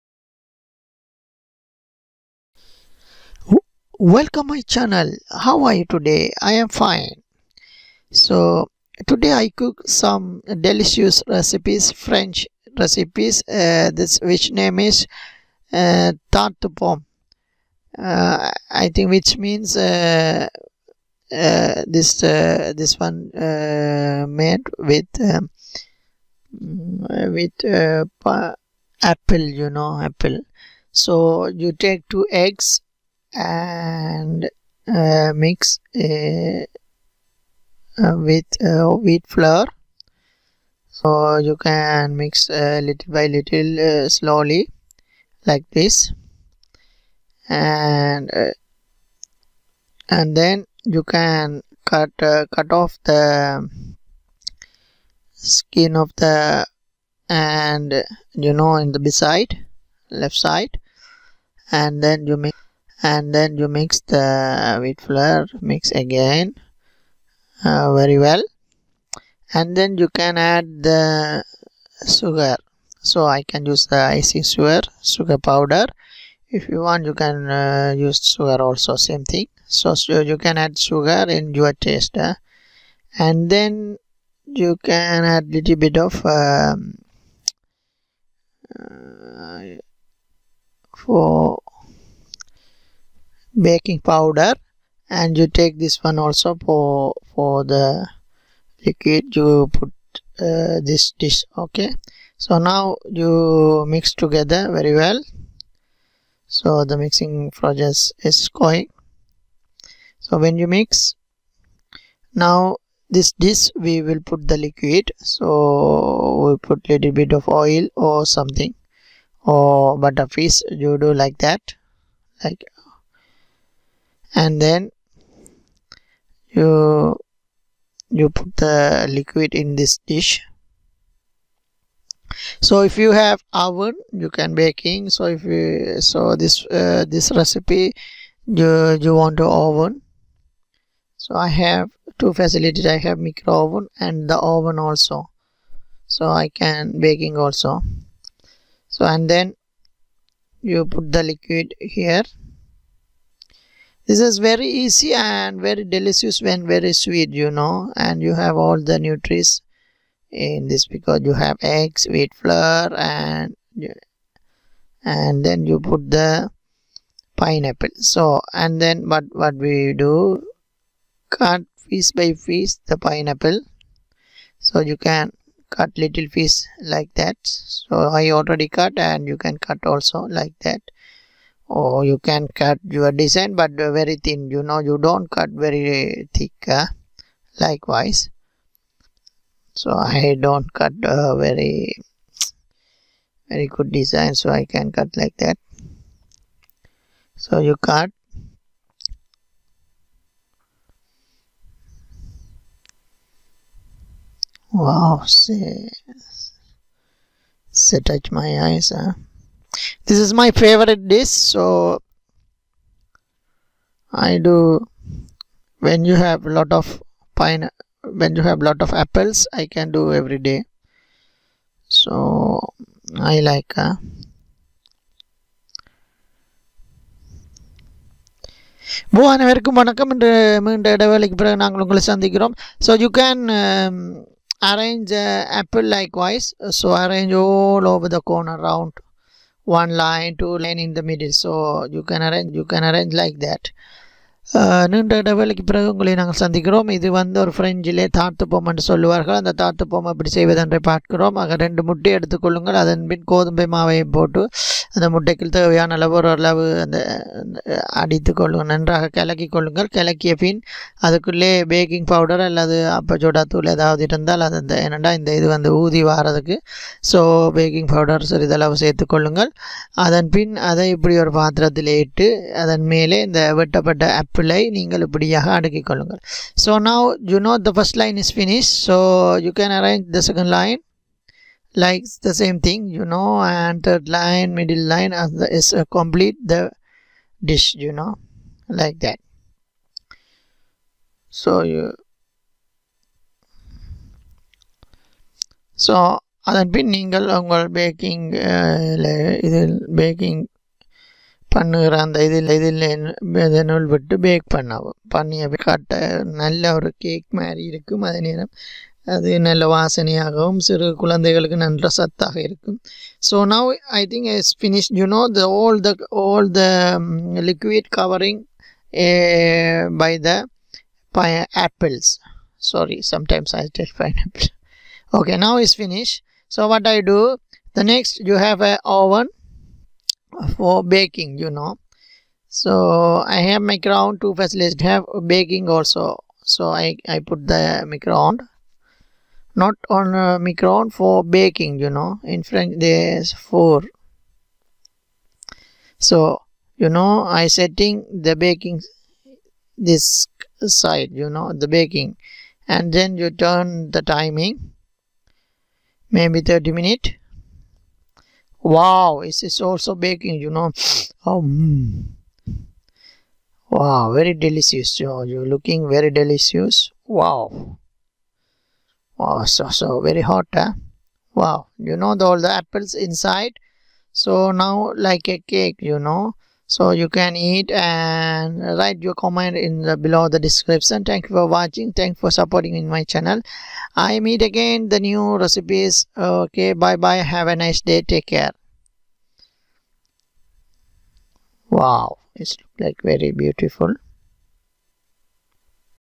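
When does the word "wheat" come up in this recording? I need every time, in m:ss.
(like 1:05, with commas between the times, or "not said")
0:38, 1:04, 2:42.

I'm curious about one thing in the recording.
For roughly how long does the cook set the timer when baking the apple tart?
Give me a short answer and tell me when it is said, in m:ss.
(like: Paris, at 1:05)
30 minutes, at 5:56.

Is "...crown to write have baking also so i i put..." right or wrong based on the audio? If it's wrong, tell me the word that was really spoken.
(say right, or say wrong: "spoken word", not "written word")
wrong: "facilitate", not "write".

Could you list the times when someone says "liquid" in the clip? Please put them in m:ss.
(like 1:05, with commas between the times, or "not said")
1:38, 1:54, 2:09, 2:31.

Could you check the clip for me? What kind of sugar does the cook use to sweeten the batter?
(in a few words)
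icing sugar.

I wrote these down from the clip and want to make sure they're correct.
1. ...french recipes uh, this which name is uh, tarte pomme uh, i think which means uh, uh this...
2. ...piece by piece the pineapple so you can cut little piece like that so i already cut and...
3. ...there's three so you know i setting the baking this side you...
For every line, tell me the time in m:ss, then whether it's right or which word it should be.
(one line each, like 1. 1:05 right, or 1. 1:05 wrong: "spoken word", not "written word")
1. 0:11 right
2. 2:51 right
3. 5:42 wrong: "four", not "three".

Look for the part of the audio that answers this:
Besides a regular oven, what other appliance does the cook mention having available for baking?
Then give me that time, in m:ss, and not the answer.
2:23.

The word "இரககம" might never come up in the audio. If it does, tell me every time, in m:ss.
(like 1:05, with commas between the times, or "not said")
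5:07, 5:12.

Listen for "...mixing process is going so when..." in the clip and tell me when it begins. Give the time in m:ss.
1:46.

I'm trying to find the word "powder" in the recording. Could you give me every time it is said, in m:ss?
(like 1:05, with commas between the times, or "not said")
1:15, 1:33.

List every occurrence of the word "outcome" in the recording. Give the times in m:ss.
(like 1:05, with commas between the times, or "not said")
not said.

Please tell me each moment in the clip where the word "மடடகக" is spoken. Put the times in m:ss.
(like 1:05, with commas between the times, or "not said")
4:15.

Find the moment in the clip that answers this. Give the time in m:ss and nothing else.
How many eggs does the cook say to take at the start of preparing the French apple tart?
0:32.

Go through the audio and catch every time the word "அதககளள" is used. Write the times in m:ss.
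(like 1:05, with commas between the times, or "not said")
4:21.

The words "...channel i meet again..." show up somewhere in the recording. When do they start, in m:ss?
6:23.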